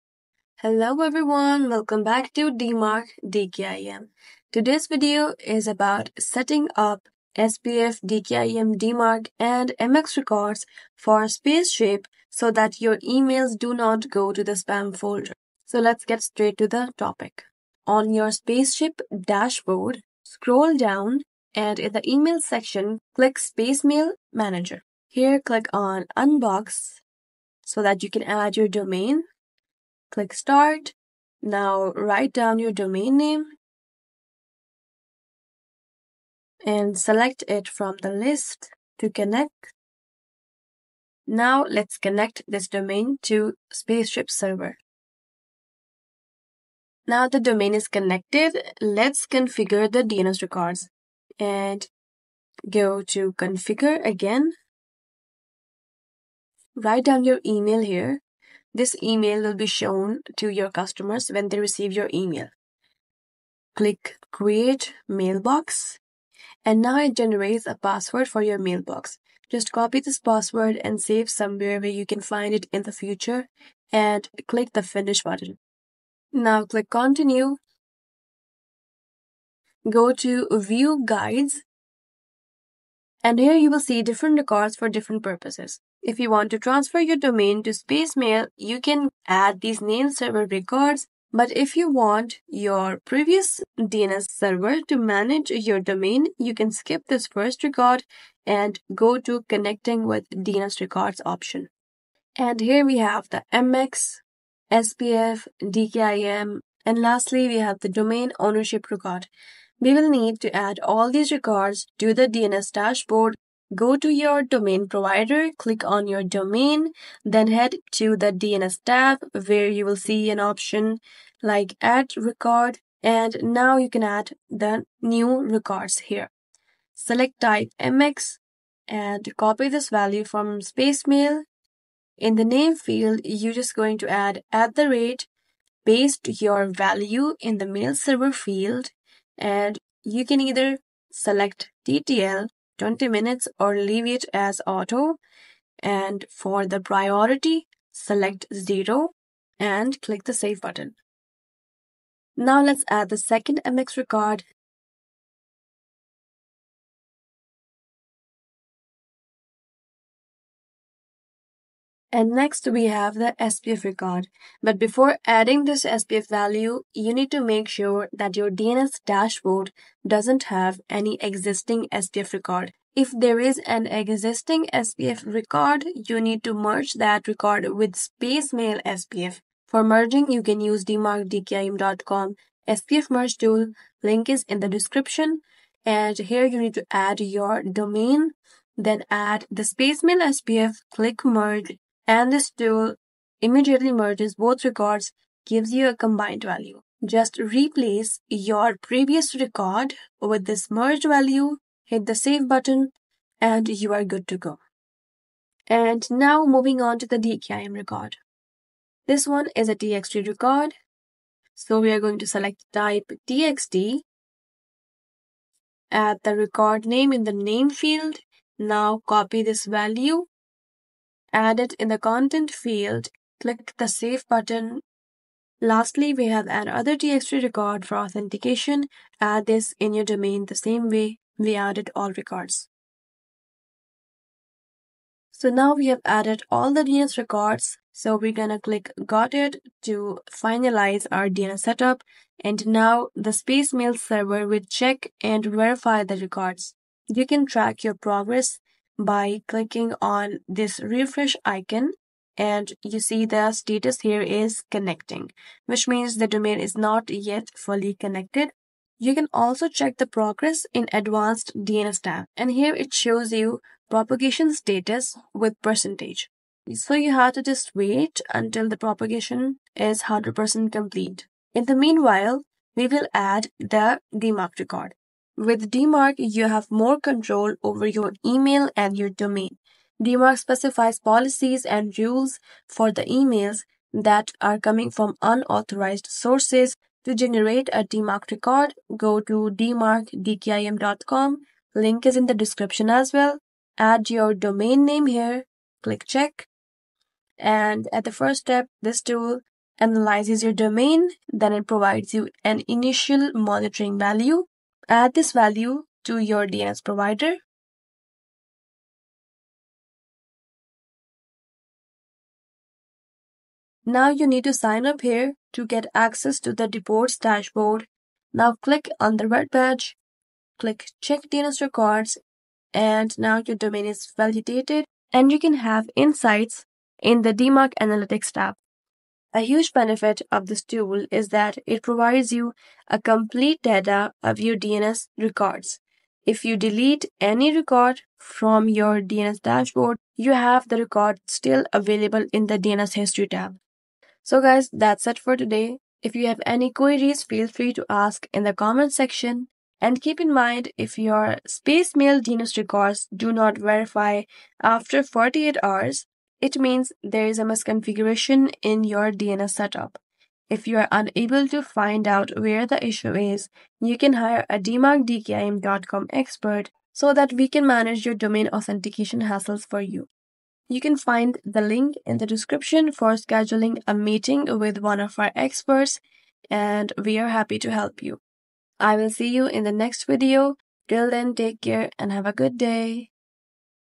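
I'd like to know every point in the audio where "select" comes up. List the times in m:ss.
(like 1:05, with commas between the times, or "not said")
0:36, 2:06, 2:21, 2:27, 3:32.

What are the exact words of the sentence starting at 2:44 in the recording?
But before adding this SPF value, you need to make sure that your DNS dashboard doesn't have any existing SPF record.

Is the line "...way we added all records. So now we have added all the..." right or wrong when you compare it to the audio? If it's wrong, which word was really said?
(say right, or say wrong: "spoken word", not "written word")
right.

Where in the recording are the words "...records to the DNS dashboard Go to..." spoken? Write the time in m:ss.
1:51.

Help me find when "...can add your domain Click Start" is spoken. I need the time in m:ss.
0:28.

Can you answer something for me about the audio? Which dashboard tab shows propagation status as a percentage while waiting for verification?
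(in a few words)
advanced DNS.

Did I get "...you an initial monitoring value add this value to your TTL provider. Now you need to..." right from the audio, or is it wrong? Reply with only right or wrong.
wrong.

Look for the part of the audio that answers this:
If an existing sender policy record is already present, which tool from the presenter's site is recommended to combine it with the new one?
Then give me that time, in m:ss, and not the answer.
3:02.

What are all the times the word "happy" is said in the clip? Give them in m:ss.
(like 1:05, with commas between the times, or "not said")
6:17.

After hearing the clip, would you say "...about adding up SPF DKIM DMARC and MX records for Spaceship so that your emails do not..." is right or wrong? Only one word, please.
wrong.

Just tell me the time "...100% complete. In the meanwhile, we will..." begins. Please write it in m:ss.
4:30.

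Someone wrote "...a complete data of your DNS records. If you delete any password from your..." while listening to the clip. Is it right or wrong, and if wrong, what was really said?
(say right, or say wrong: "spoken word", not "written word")
wrong: "record", not "password".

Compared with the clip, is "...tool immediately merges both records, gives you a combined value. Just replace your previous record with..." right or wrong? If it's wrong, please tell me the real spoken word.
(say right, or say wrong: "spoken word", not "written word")
right.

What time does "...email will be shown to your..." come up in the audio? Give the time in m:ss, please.
0:59.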